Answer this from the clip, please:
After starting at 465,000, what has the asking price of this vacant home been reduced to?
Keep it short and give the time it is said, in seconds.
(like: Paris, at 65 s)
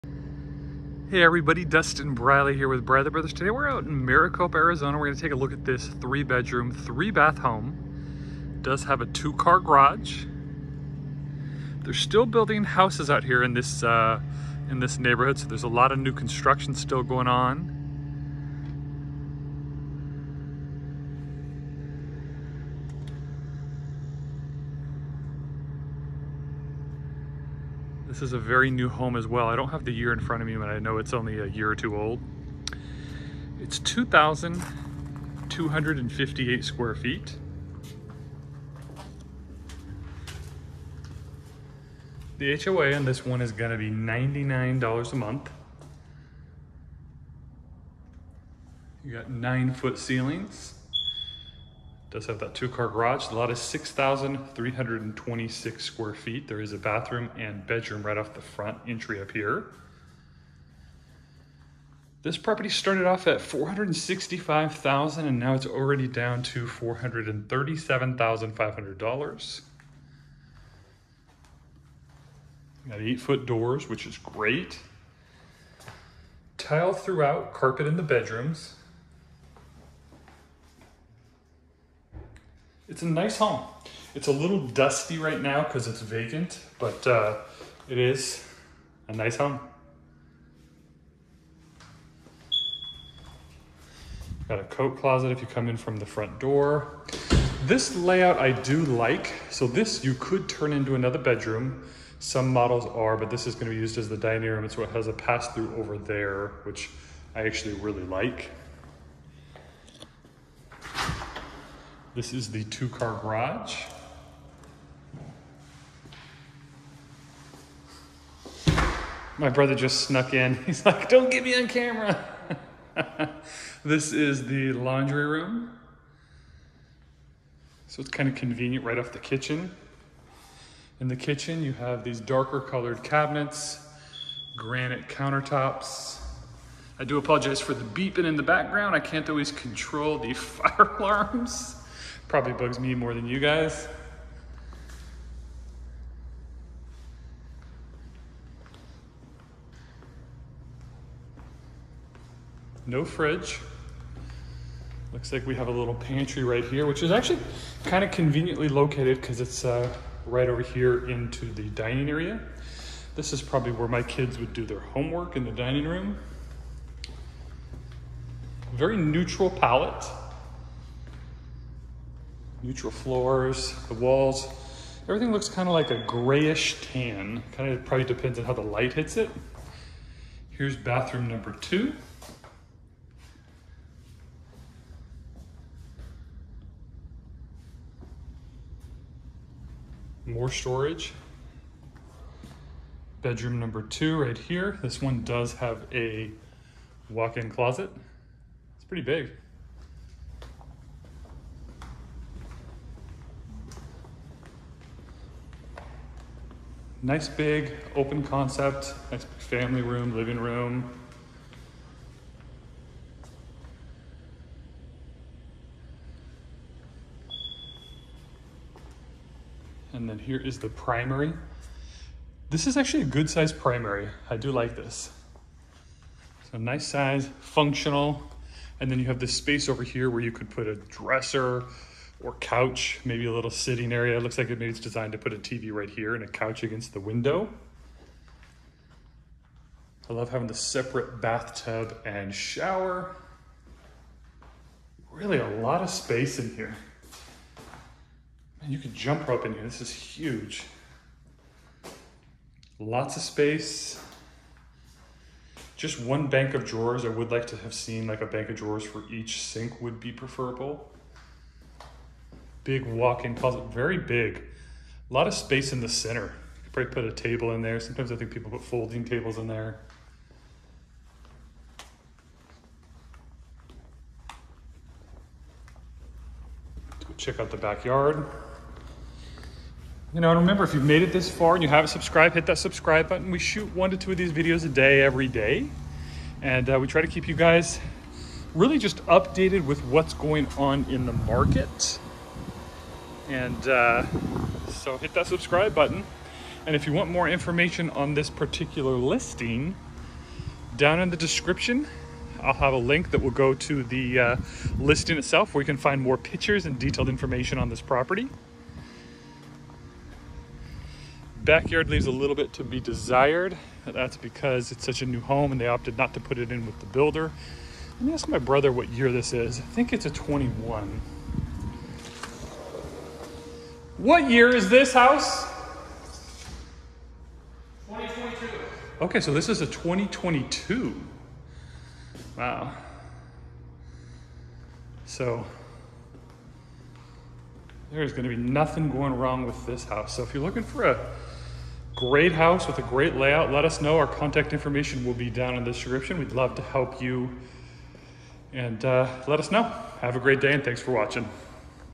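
$437,500, at 66 s.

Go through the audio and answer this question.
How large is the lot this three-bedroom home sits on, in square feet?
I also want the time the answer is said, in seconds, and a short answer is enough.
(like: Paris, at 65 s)
6,326 square feet, at 53 s.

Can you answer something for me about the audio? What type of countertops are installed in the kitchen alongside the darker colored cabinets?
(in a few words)
Granite.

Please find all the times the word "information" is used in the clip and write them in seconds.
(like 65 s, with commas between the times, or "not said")
297 s, 307 s, 344 s.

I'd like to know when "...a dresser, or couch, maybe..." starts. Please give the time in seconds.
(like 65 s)
230 s.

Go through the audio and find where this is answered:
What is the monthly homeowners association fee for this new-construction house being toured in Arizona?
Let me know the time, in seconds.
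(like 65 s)
43 s.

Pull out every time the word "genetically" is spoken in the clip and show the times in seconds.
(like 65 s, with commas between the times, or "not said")
not said.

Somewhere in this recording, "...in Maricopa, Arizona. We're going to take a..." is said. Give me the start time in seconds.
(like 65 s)
3 s.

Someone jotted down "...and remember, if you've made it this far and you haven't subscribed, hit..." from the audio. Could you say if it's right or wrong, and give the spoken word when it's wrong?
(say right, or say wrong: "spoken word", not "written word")
right.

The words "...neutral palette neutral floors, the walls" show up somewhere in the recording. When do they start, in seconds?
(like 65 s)
168 s.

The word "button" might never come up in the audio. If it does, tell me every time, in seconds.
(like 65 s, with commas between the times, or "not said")
283 s, 295 s.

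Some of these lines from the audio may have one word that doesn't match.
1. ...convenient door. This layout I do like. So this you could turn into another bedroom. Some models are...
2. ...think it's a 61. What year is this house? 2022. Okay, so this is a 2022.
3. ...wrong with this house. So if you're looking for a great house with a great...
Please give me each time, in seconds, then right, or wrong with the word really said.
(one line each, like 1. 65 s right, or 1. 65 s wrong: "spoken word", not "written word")
1. 96 s wrong: "front", not "convenient"
2. 319 s wrong: "21", not "61"
3. 339 s right.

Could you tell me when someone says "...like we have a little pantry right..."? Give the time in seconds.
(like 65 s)
155 s.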